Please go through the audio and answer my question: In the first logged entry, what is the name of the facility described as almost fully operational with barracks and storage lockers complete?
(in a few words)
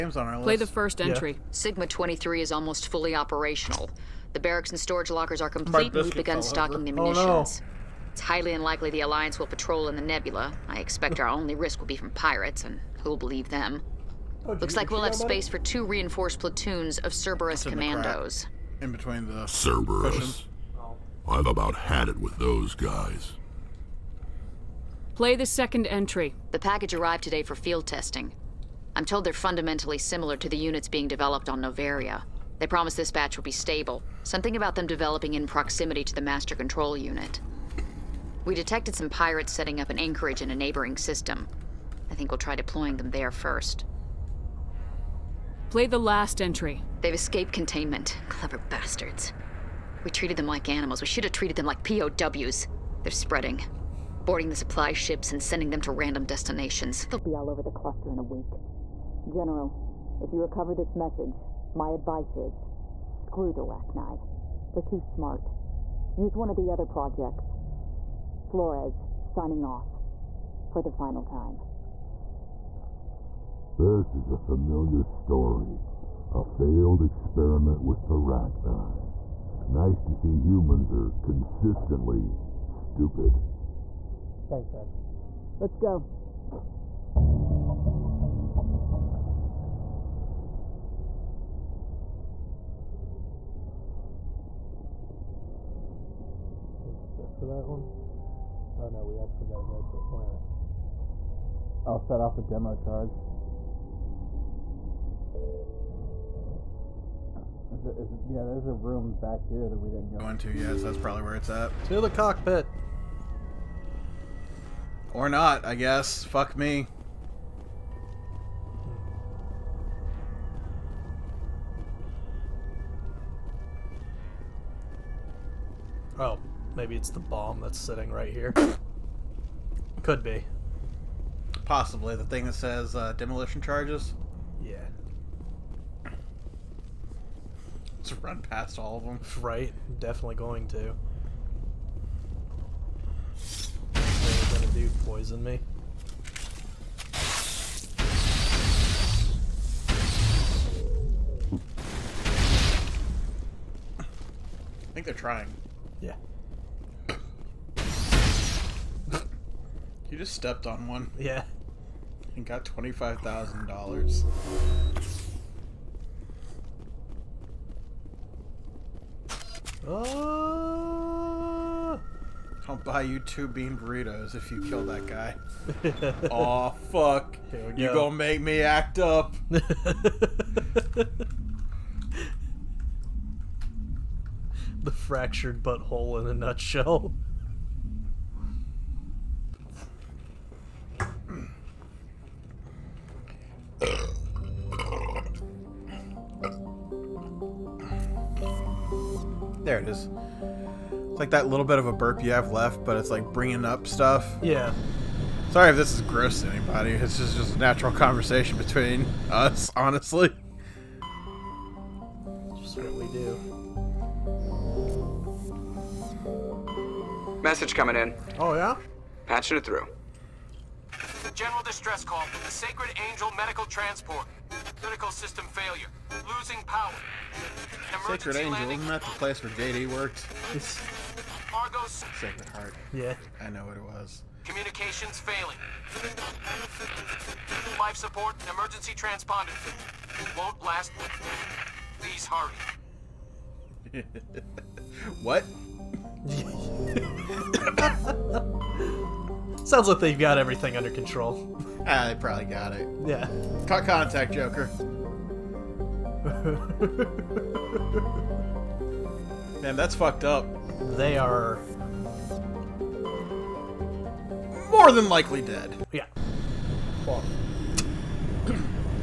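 Sigma 23.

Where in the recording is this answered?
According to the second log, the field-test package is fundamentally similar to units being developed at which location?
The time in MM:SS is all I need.
00:31.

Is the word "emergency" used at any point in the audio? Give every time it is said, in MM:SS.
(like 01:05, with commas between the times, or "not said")
03:47, 03:58.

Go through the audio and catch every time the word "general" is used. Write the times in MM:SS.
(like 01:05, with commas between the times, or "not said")
00:59, 03:41.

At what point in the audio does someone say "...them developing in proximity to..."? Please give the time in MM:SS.
00:34.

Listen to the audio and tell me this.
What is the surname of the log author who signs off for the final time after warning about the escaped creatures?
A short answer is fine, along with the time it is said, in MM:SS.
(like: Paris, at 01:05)
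Flores, at 01:08.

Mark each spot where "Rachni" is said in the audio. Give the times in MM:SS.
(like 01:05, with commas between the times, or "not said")
01:03, 01:18.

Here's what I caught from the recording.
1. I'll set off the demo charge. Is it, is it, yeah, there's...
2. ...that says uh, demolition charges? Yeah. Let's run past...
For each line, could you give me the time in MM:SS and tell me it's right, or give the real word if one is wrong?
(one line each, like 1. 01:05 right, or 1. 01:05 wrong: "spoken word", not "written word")
1. 01:41 right
2. 02:12 right.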